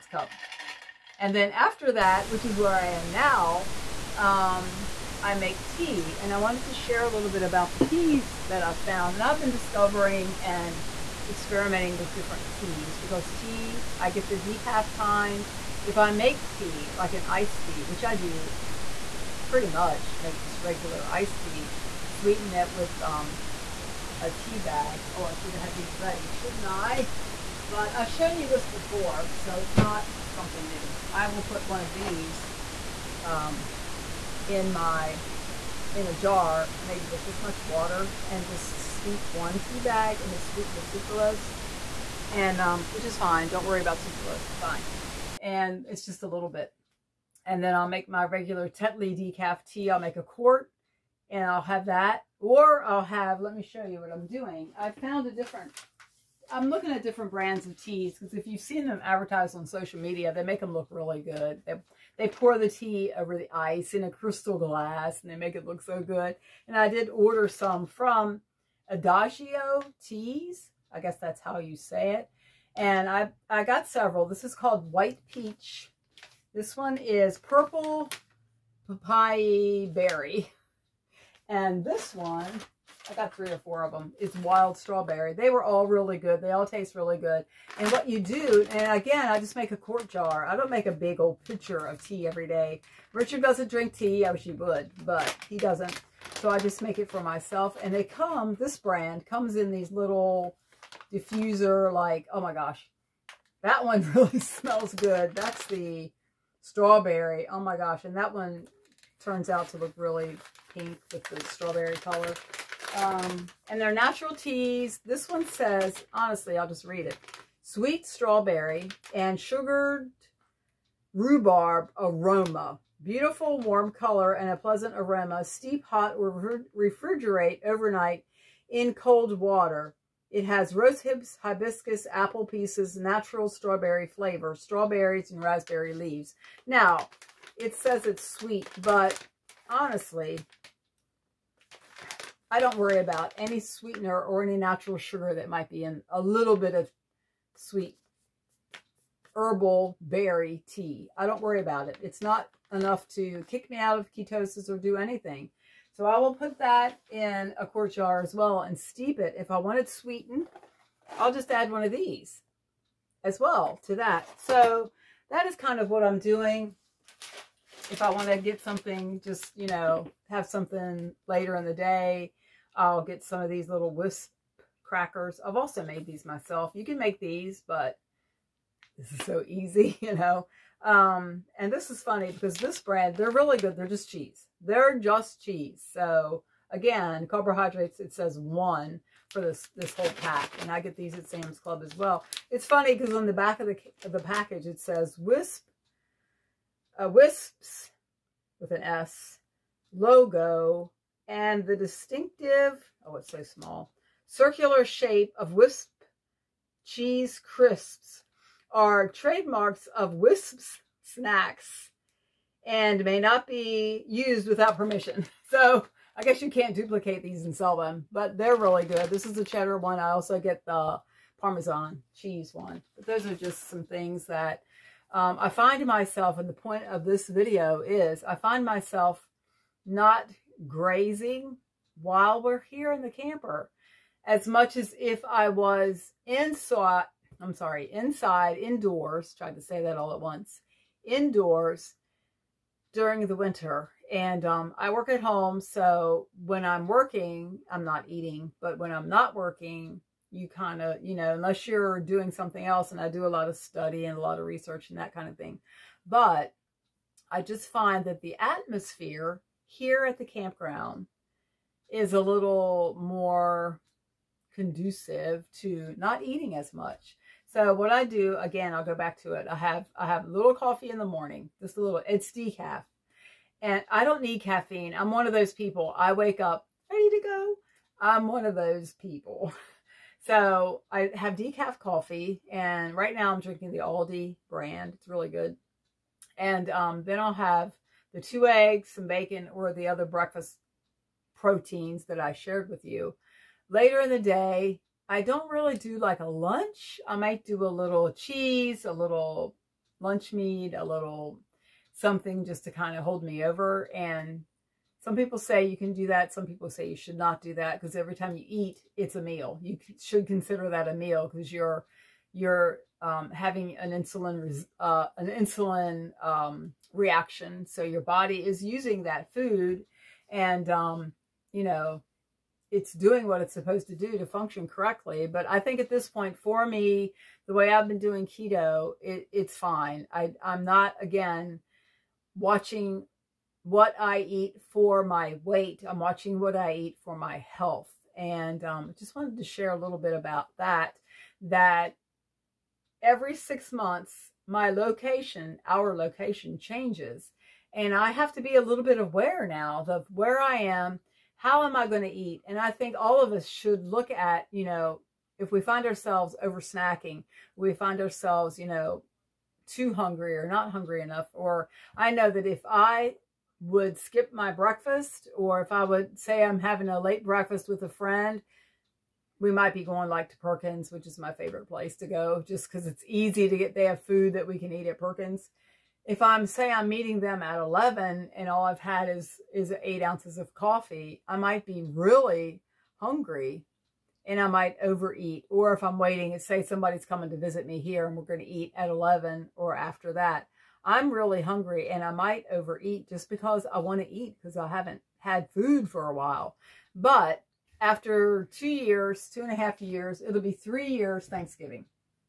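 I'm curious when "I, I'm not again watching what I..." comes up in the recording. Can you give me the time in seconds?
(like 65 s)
330 s.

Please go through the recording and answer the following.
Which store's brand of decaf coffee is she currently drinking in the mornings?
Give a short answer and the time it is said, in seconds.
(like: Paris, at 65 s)
Aldi, at 283 s.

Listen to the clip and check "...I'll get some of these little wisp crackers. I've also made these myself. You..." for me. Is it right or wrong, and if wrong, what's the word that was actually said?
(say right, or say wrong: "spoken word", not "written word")
right.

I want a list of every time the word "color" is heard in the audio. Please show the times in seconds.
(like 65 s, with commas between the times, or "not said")
111 s, 123 s.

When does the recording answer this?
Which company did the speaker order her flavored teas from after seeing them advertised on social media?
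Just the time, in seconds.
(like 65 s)
68 s.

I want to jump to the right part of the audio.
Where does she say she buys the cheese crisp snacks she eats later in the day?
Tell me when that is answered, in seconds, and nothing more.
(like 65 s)
191 s.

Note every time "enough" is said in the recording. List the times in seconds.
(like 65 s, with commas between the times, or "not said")
152 s, 360 s.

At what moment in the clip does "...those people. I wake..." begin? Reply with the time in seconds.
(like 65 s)
275 s.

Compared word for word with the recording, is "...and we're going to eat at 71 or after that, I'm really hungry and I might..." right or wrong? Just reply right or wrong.
wrong.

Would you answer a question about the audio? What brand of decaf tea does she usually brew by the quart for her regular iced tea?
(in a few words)
Tetley.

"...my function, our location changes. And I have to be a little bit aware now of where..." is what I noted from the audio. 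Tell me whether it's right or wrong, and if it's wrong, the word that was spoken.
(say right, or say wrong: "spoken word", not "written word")
wrong: "location", not "function".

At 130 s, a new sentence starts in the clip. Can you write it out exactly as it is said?
It has rose hips, hibiscus, apple pieces, natural strawberry flavor, strawberries and raspberry leaves.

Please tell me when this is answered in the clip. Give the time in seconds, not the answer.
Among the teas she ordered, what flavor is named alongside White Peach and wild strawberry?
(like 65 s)
77 s.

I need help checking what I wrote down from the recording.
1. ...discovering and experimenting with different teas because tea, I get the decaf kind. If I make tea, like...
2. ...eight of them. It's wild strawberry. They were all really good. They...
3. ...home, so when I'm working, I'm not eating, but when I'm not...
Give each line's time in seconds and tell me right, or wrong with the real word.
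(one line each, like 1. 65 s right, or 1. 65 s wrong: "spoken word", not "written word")
1. 9 s right
2. 83 s wrong: "four", not "eight"
3. 245 s right.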